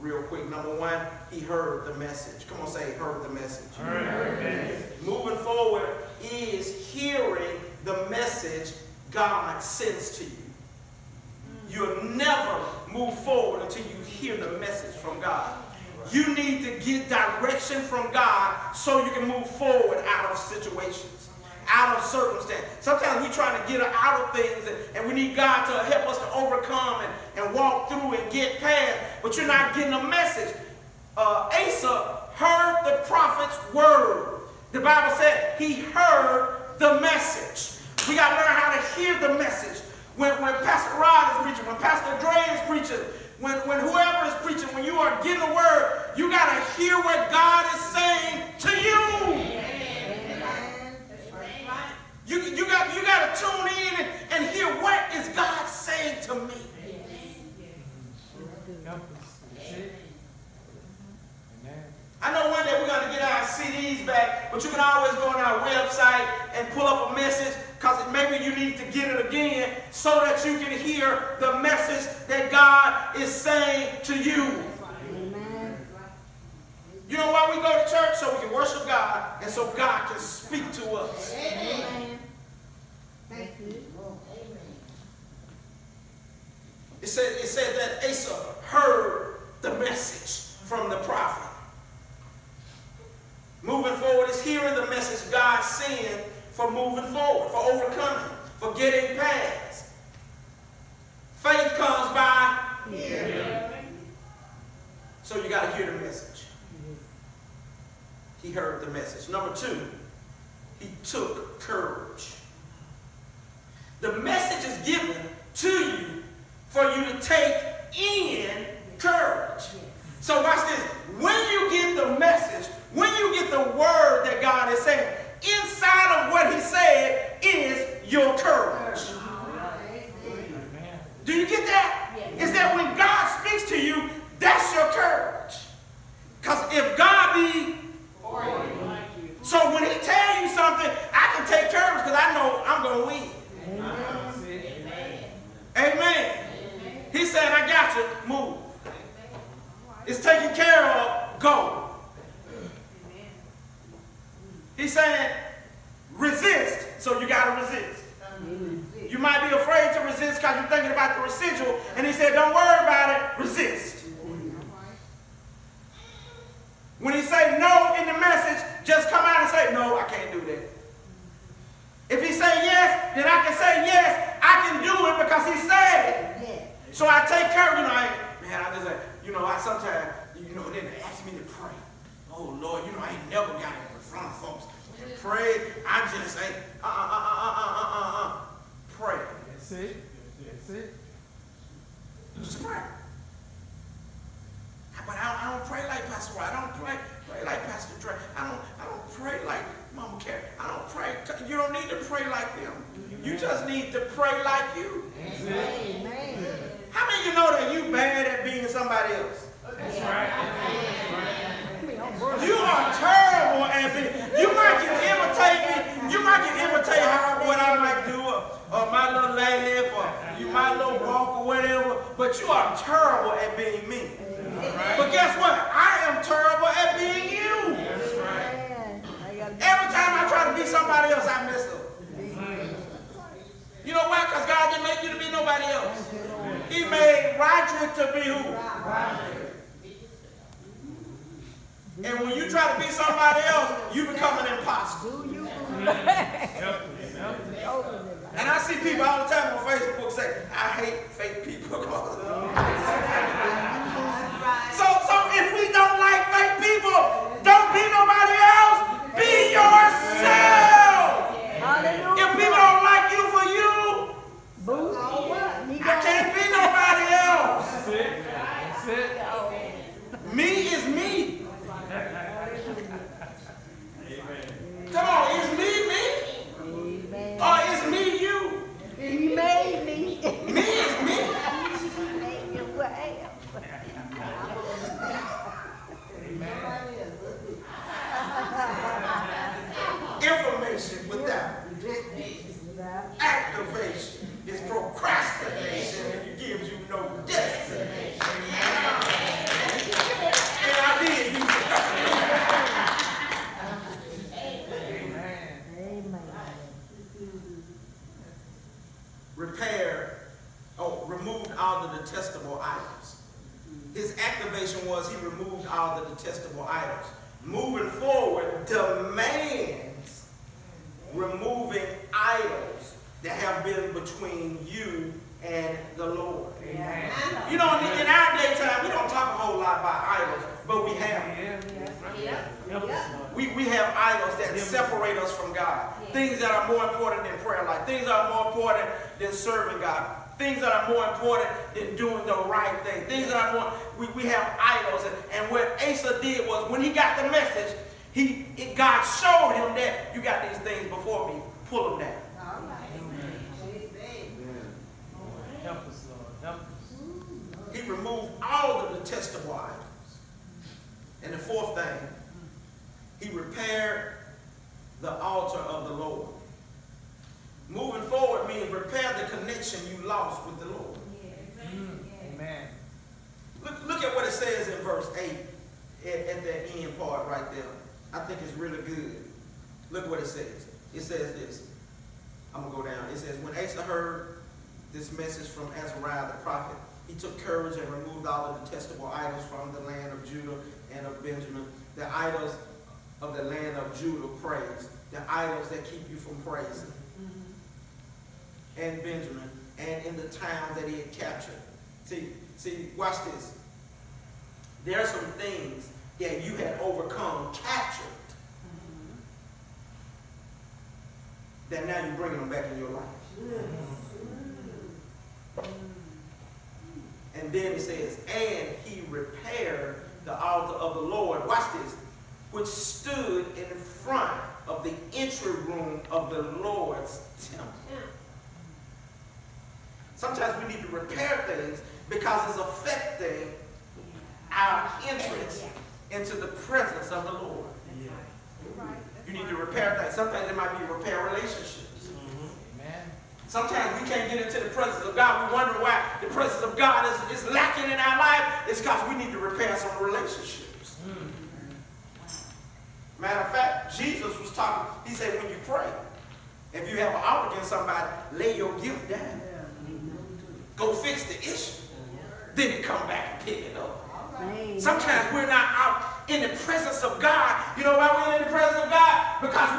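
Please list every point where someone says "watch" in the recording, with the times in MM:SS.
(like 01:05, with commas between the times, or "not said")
02:00, 06:42, 07:01.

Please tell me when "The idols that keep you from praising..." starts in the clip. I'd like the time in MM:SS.
06:35.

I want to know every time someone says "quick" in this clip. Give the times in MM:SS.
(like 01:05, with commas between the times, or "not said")
00:00.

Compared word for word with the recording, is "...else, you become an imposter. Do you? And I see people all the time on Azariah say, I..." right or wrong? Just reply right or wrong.
wrong.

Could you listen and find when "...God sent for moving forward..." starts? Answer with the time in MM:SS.
01:35.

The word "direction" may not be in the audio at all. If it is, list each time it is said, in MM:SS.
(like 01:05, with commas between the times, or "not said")
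00:17.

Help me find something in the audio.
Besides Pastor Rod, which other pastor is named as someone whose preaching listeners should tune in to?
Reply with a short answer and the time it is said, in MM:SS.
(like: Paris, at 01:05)
Pastor Dre, at 00:41.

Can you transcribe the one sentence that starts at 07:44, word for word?
Sometimes we're not out in the presence of God.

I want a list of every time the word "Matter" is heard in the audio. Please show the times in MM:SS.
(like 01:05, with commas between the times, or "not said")
07:33.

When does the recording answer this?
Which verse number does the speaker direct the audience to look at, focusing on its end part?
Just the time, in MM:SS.
06:14.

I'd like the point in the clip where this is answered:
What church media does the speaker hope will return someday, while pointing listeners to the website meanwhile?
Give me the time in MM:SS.
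01:03.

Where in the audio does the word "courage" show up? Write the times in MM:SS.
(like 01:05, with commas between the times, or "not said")
01:51, 01:58, 02:08, 06:27.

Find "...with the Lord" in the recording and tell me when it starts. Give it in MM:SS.
06:10.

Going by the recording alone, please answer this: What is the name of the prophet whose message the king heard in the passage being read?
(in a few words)
Azariah.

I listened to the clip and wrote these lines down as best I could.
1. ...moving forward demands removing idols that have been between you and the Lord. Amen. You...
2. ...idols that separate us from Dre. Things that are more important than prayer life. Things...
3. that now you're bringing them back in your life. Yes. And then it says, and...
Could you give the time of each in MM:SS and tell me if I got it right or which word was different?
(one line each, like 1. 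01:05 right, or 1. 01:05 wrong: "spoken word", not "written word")
1. 05:17 right
2. 05:33 wrong: "God", not "Dre"
3. 06:51 right.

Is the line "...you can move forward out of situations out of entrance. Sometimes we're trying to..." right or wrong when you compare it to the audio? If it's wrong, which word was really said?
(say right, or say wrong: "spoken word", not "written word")
wrong: "circumstance", not "entrance".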